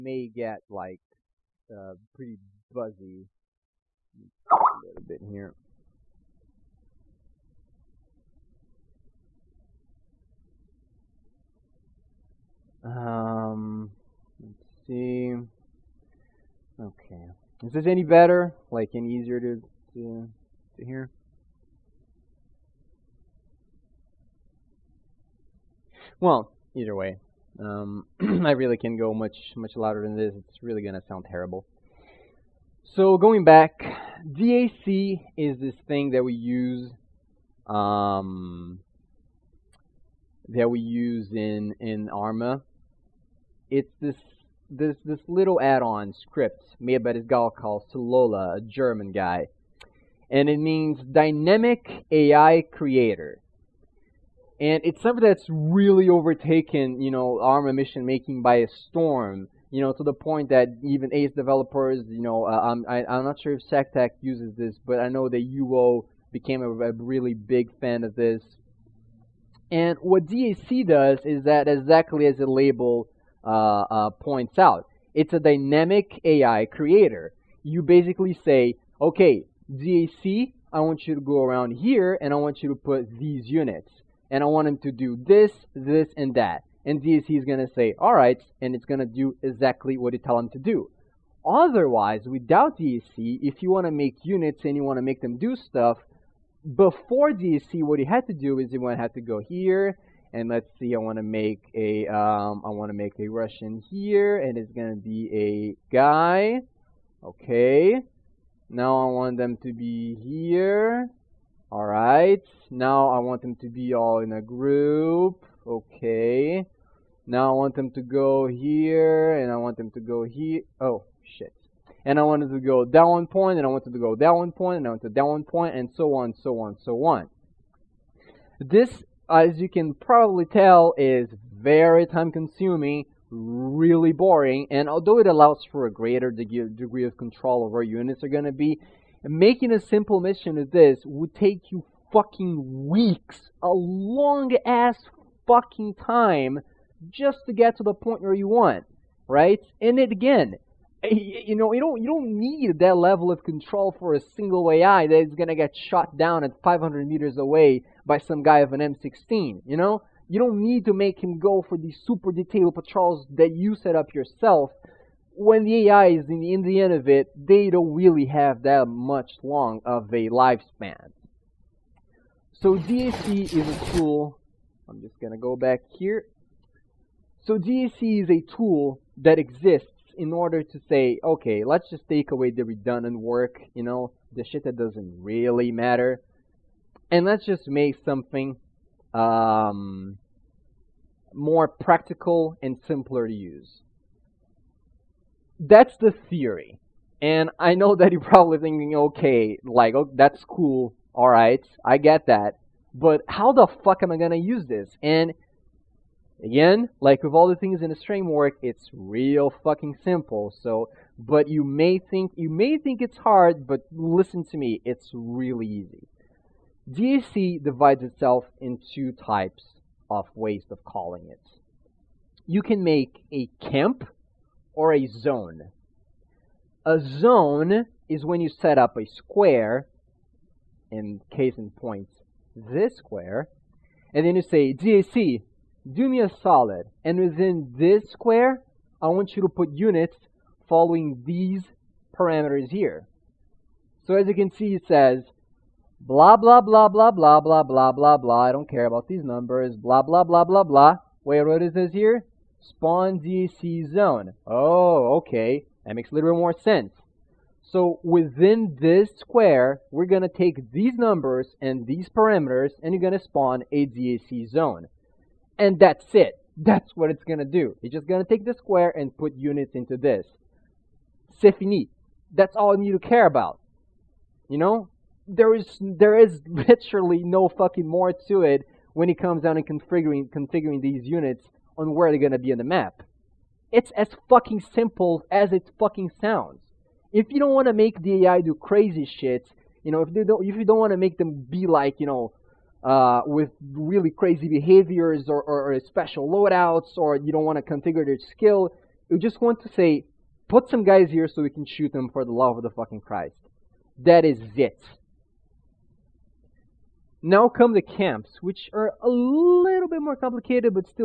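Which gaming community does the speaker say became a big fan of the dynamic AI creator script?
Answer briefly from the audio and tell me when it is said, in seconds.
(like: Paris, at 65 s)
UO, at 65 s.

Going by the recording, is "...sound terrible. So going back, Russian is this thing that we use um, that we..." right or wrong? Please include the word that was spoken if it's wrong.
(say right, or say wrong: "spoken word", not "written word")
wrong: "DAC", not "Russian".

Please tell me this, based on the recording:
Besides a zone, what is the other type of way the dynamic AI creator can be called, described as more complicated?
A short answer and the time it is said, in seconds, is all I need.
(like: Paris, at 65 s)
camp, at 223 s.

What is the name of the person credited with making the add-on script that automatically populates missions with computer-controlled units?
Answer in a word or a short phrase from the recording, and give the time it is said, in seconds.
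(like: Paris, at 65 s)
Solola, at 47 s.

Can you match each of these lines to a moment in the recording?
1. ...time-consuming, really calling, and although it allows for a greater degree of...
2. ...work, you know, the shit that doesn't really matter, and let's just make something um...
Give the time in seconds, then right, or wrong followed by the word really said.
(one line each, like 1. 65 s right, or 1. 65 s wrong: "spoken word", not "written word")
1. 132 s wrong: "boring", not "calling"
2. 183 s right.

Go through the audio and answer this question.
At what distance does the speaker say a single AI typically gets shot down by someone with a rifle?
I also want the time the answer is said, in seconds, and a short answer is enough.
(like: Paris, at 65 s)
500 meters, at 156 s.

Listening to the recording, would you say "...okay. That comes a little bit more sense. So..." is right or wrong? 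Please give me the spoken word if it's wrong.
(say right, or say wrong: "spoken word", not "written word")
wrong: "makes", not "comes".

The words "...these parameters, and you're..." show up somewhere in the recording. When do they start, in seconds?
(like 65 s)
261 s.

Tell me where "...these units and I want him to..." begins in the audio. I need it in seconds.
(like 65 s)
83 s.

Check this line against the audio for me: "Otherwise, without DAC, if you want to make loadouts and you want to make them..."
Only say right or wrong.
wrong.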